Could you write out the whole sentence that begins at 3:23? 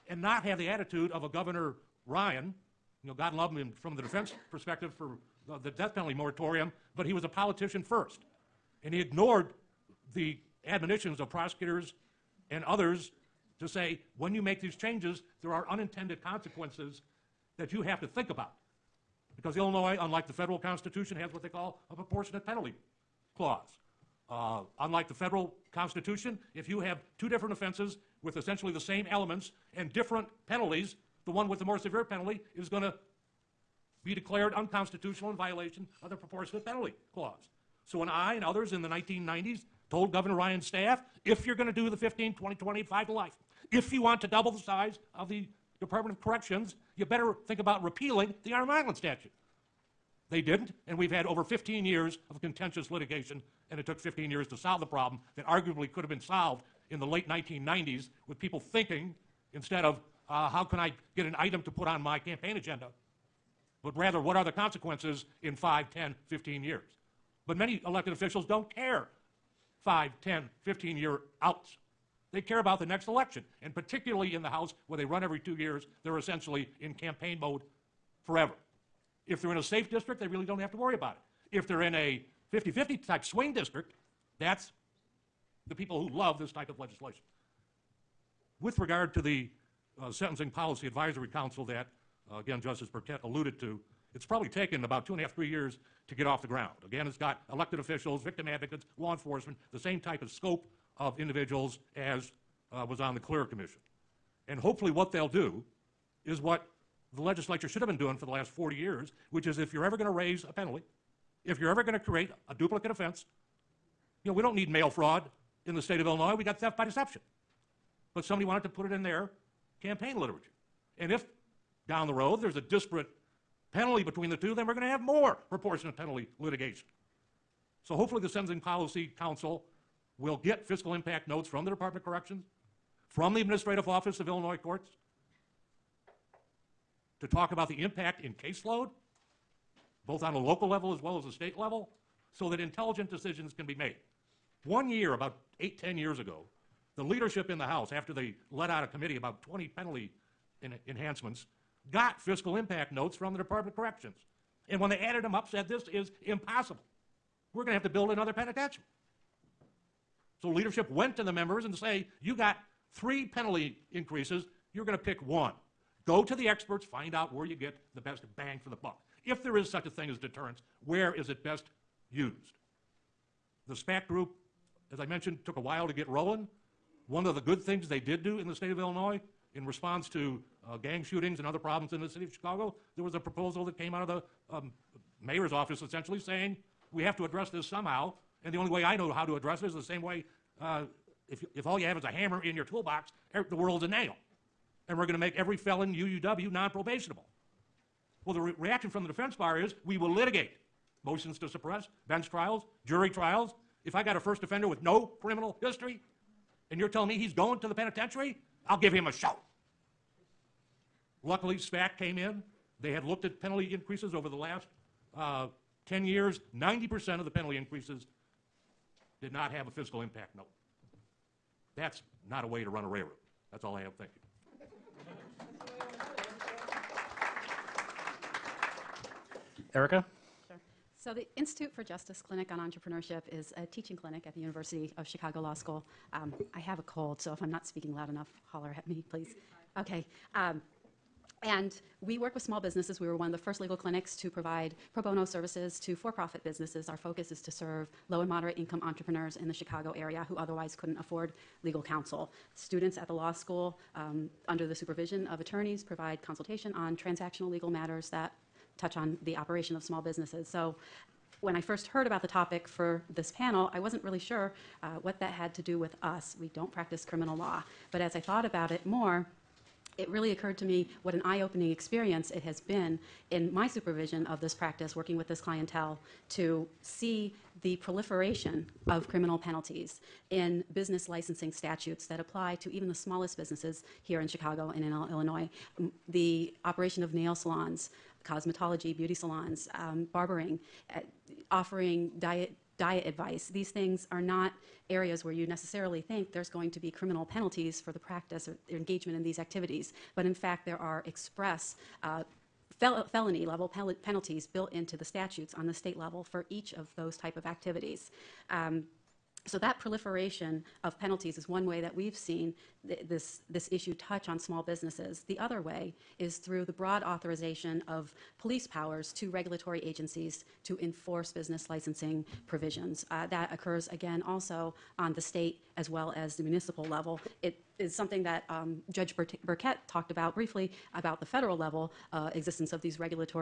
If I got a first offender with no criminal history, and you're telling me he's going to the penitentiary?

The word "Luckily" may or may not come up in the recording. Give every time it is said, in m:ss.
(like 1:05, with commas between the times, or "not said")
3:31.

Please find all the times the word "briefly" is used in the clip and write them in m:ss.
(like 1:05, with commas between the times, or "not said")
5:30.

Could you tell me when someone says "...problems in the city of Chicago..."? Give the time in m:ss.
3:01.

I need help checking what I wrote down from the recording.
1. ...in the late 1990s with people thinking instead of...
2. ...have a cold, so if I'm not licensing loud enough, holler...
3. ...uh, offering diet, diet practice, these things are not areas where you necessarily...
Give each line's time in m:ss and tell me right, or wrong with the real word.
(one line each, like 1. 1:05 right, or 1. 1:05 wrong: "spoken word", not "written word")
1. 0:56 right
2. 3:56 wrong: "speaking", not "licensing"
3. 4:50 wrong: "advice", not "practice".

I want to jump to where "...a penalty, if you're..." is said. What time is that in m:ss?
1:50.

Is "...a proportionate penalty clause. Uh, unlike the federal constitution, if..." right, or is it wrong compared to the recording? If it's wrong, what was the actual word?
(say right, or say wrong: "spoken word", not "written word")
right.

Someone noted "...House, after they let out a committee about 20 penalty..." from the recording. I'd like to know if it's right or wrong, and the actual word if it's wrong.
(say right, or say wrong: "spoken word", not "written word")
right.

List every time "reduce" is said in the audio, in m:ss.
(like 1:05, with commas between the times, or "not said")
not said.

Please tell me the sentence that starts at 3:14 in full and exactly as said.
And we're going to make every felon UUW non probationable.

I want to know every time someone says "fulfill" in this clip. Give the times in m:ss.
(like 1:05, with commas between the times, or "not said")
not said.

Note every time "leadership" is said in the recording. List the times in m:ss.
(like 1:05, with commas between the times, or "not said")
2:27, 2:40.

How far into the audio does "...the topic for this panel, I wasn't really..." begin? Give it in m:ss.
4:22.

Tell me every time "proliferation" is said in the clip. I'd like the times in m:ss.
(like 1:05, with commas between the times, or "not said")
4:37, 5:09.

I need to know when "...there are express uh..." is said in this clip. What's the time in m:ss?
5:00.